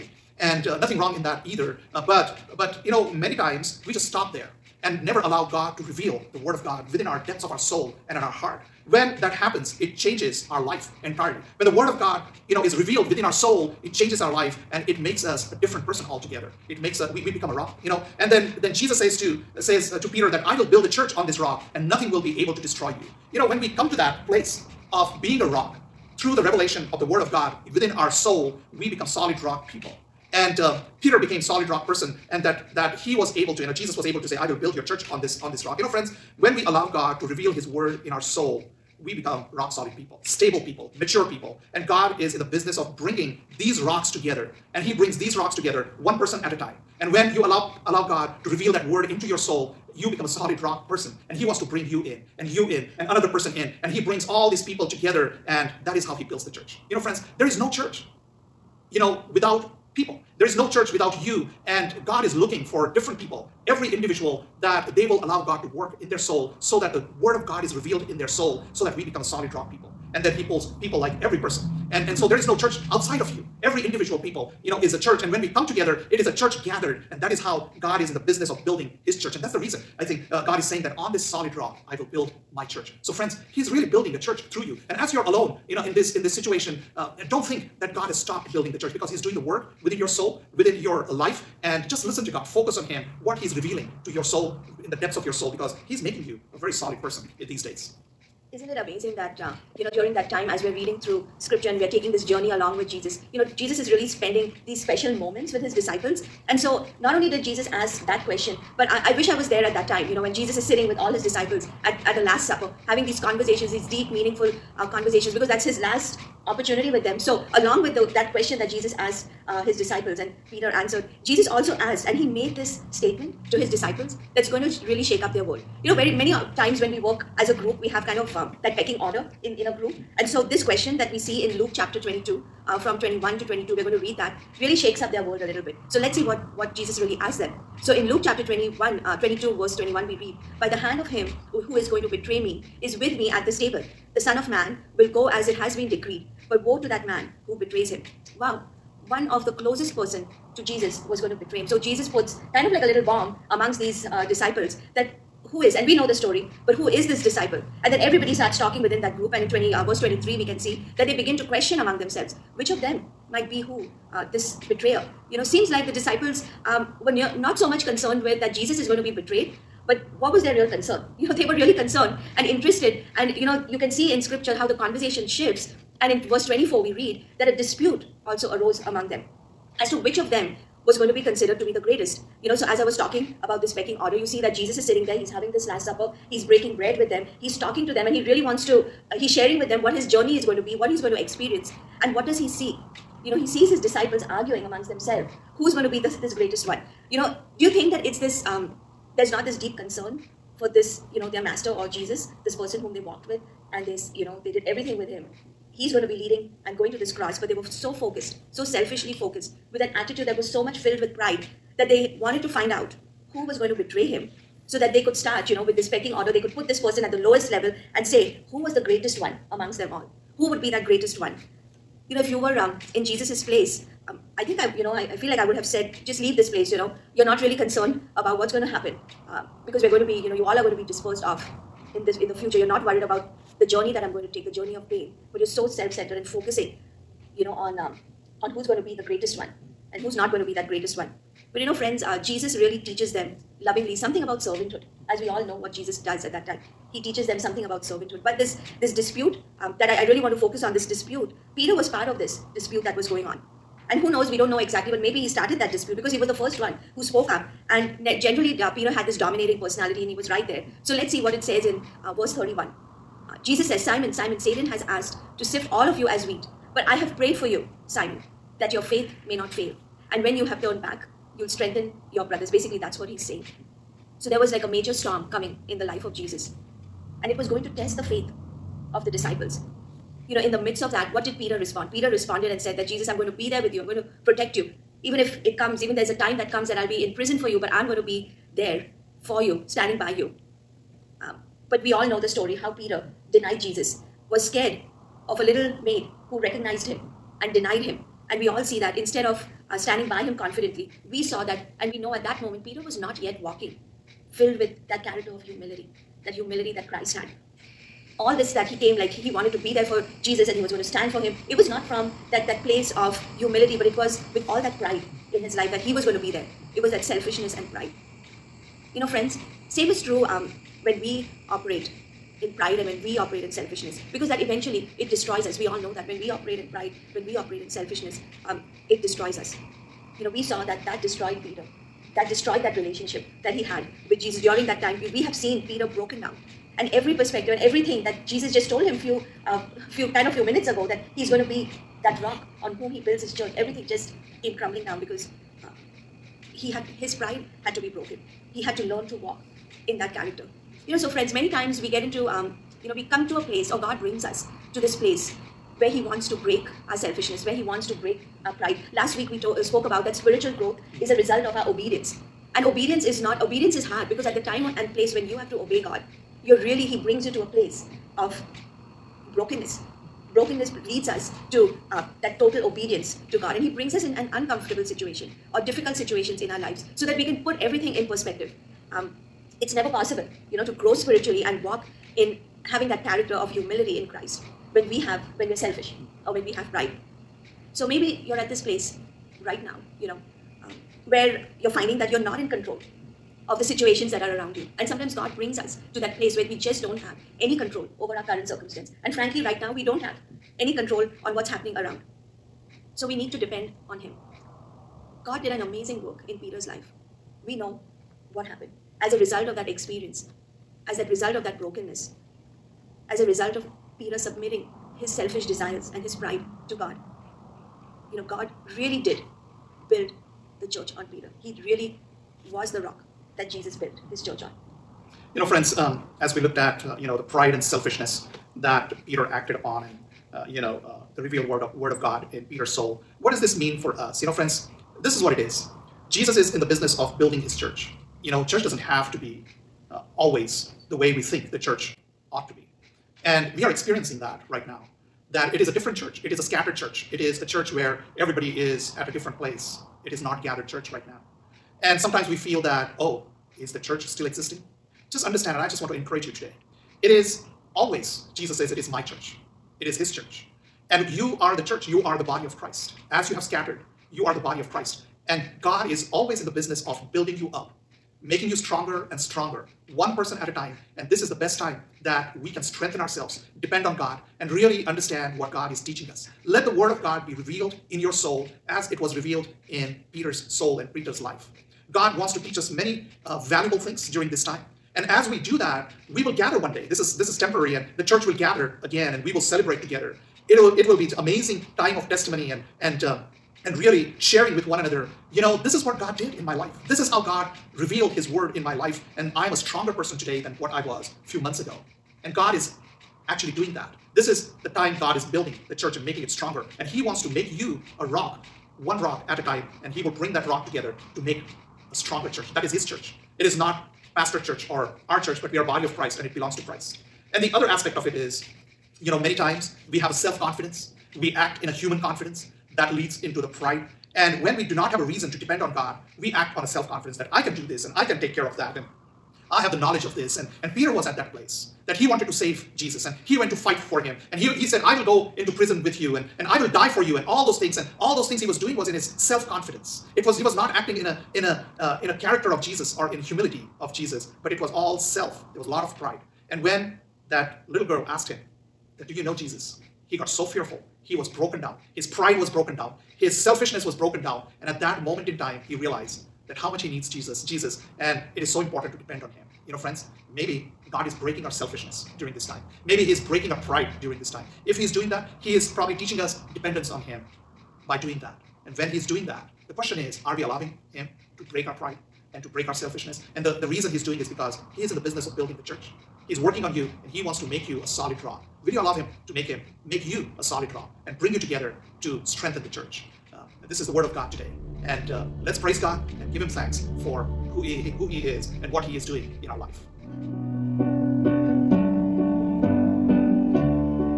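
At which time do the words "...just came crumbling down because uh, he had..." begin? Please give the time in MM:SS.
05:43.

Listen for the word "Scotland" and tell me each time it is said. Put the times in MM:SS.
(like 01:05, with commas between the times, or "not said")
not said.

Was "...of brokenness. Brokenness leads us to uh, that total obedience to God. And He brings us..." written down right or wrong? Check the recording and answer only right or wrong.
right.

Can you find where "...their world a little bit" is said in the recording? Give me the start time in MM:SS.
02:15.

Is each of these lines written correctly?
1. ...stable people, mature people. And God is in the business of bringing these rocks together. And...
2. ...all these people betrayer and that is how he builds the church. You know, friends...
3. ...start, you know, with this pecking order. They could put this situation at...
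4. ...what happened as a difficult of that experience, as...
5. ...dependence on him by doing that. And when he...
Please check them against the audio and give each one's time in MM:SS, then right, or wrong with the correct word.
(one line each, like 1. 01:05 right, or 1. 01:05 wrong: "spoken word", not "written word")
1. 00:40 right
2. 00:54 wrong: "together", not "betrayer"
3. 03:35 wrong: "person", not "situation"
4. 06:48 wrong: "result", not "difficult"
5. 09:26 right.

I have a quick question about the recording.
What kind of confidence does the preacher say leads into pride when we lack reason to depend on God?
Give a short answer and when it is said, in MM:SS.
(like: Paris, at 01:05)
Human confidence, at 08:41.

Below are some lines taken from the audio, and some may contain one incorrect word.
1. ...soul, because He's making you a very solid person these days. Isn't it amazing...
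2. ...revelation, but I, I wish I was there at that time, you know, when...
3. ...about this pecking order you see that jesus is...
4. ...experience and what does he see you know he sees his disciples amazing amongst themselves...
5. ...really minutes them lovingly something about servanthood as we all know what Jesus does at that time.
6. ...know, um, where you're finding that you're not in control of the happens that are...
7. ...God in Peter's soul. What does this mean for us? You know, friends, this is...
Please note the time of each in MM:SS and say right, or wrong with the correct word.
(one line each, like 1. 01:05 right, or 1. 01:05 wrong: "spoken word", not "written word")
1. 01:35 right
2. 01:48 wrong: "question", not "revelation"
3. 03:03 right
4. 03:11 wrong: "arguing", not "amazing"
5. 04:02 wrong: "teaches", not "minutes"
6. 06:30 wrong: "situations", not "happens"
7. 07:12 right.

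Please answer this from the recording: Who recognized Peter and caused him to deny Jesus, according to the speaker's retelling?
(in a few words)
A little maid.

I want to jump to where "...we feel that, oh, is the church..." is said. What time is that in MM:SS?
07:32.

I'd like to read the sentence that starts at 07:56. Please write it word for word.
Let the Word of God be revealed in your soul as it was revealed in Peter's soul and Peter's life.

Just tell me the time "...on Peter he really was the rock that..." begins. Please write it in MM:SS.
07:00.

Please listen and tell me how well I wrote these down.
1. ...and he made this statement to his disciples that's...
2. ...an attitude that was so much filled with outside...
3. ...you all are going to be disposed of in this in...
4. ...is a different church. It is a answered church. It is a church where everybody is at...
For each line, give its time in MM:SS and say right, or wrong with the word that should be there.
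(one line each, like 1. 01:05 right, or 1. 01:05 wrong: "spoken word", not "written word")
1. 02:02 right
2. 03:29 wrong: "pride", not "outside"
3. 03:50 right
4. 07:25 wrong: "scattered", not "answered".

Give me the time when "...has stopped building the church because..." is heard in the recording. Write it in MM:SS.
01:28.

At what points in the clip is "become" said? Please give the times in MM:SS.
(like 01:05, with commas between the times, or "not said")
00:17, 00:28, 00:39, 00:50, 01:09.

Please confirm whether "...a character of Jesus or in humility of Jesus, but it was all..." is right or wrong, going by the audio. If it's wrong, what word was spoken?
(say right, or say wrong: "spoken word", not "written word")
right.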